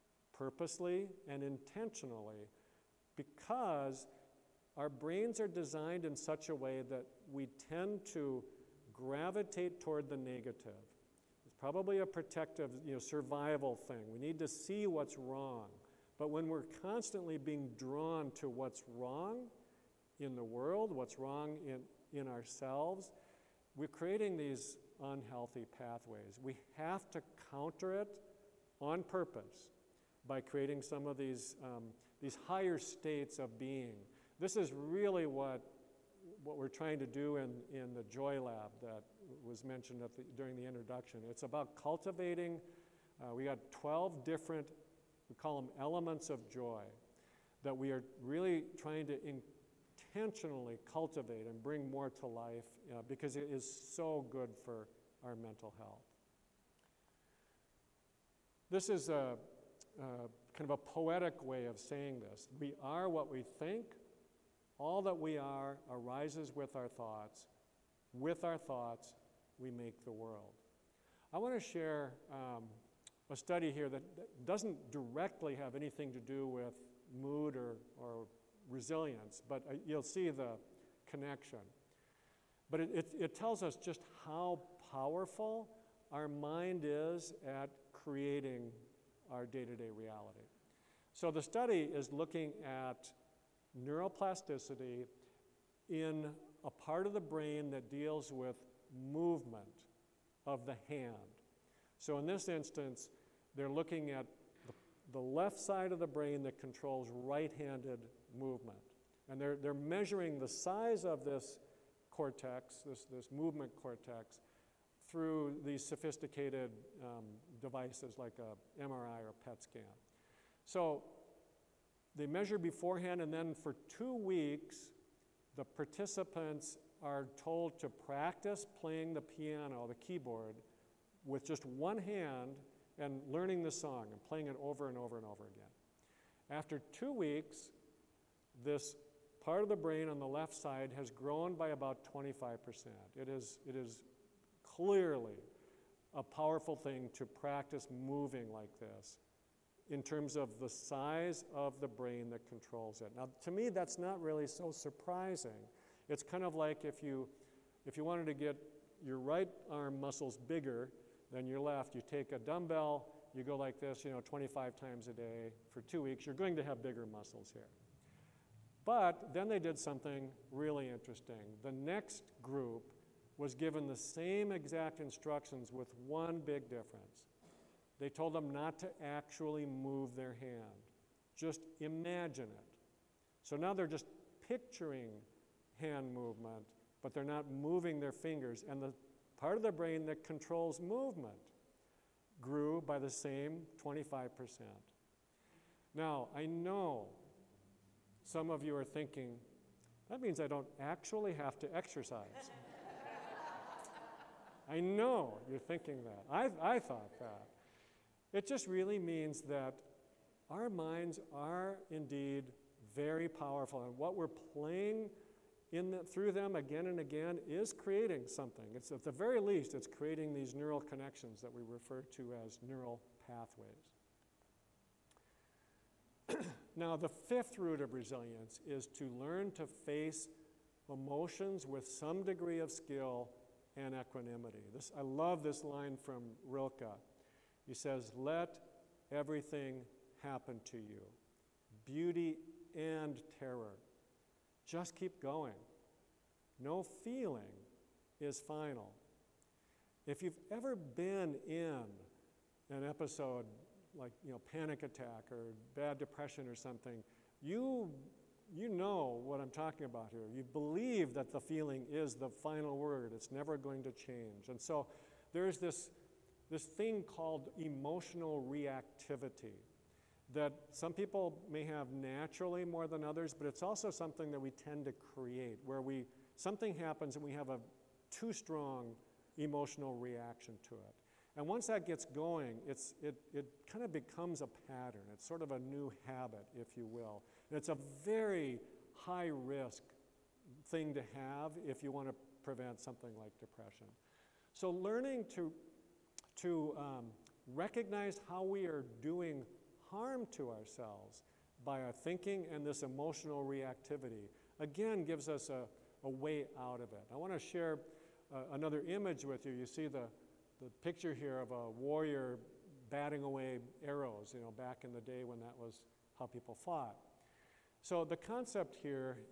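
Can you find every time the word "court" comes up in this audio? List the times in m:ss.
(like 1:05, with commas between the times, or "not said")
not said.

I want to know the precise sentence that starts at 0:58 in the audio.
This is a, a kind of a poetic way of saying this.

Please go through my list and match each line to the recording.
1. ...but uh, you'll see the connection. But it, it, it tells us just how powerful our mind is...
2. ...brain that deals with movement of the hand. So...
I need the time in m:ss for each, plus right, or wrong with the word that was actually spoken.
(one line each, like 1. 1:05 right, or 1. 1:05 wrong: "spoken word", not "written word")
1. 1:19 right
2. 1:37 right.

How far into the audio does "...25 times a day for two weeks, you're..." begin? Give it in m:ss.
2:44.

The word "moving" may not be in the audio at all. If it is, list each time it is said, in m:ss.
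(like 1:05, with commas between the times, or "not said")
2:27, 3:07.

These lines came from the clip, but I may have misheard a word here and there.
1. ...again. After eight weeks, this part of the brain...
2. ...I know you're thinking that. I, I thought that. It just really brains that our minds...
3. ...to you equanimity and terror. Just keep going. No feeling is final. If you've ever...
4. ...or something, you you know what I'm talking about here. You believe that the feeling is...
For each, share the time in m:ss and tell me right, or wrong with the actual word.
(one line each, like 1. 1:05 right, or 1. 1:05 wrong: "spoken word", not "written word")
1. 2:15 wrong: "two", not "eight"
2. 3:24 wrong: "means", not "brains"
3. 4:00 wrong: "beauty", not "equanimity"
4. 4:16 right.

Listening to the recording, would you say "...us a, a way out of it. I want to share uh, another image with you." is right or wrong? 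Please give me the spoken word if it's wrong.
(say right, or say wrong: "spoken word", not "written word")
right.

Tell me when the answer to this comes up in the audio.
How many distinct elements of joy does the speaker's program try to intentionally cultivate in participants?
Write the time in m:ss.
0:43.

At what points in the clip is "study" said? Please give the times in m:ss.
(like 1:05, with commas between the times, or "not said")
1:13, 1:31.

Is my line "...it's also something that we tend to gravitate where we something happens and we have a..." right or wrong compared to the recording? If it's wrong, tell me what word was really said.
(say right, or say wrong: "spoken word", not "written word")
wrong: "create", not "gravitate".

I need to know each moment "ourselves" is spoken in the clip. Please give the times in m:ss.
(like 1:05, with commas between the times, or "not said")
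0:22, 5:00.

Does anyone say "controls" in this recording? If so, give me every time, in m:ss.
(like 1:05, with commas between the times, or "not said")
1:46, 2:32, 3:10.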